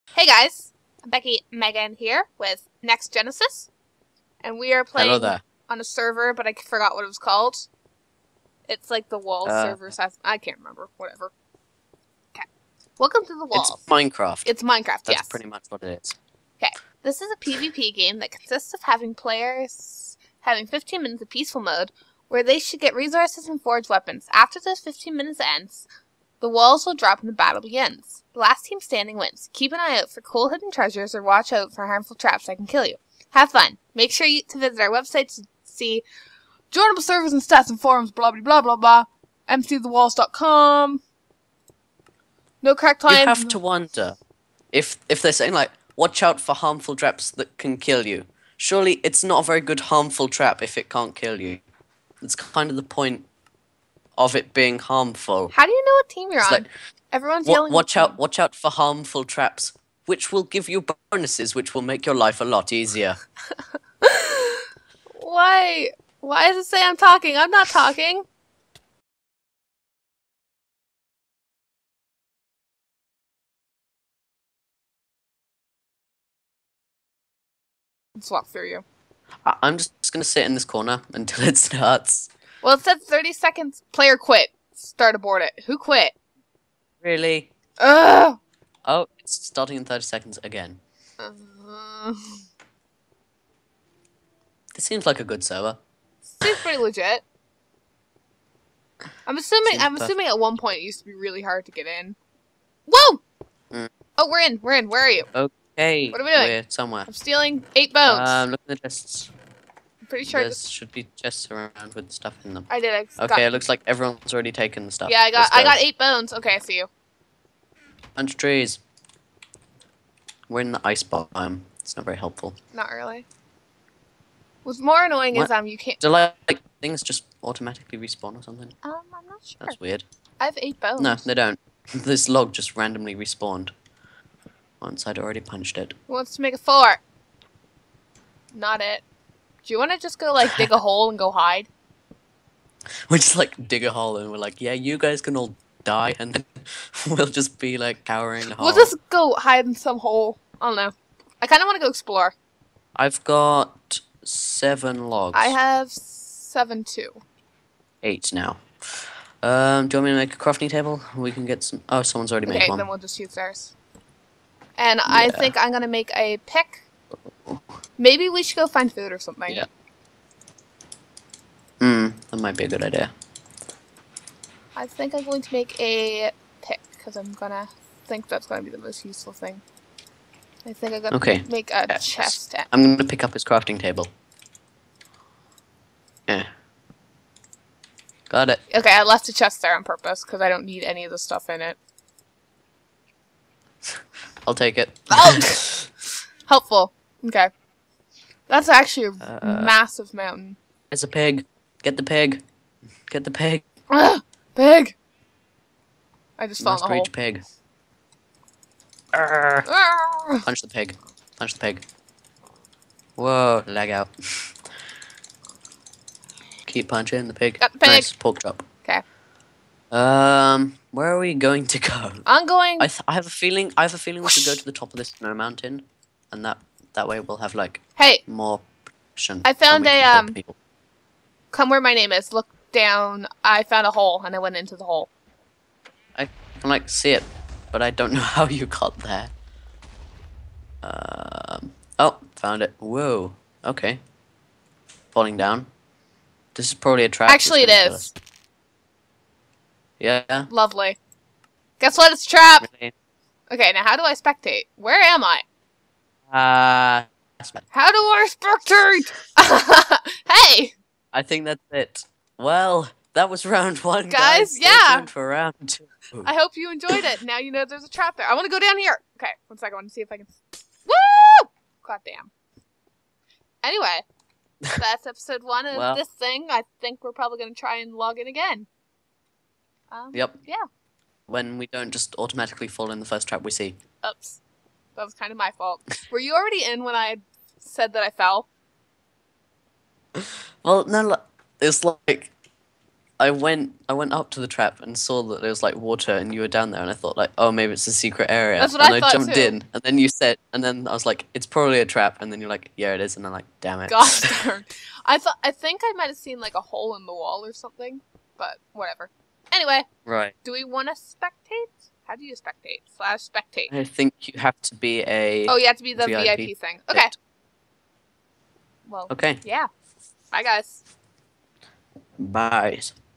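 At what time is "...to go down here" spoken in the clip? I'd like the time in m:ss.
4:28.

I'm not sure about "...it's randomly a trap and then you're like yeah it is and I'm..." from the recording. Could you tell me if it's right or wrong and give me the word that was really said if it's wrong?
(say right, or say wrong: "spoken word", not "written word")
wrong: "probably", not "randomly".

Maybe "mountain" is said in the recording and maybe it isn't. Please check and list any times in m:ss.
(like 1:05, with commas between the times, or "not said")
3:20, 3:45.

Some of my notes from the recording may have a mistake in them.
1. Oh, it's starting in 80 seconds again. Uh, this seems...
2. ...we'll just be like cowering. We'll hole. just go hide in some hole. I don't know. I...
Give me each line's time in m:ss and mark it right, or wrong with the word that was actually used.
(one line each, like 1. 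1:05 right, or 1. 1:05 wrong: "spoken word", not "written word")
1. 1:28 wrong: "30", not "80"
2. 2:27 right.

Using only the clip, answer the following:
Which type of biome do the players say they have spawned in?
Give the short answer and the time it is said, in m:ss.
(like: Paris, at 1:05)
Ice biome, at 2:00.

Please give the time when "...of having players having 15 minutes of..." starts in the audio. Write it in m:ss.
0:18.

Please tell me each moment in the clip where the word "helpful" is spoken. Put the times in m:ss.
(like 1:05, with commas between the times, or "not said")
2:02, 3:16.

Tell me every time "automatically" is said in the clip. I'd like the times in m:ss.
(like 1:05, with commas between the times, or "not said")
2:07, 4:42.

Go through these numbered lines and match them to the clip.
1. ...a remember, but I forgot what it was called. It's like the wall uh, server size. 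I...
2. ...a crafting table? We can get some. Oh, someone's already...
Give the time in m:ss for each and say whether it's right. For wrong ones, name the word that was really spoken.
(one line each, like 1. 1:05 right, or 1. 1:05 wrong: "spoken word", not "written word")
1. 0:05 wrong: "server", not "remember"
2. 2:40 right.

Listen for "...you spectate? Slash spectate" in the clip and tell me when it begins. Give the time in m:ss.
5:12.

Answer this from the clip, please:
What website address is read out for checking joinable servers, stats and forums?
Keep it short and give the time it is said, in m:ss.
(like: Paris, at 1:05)
MCTheWalls.com, at 0:39.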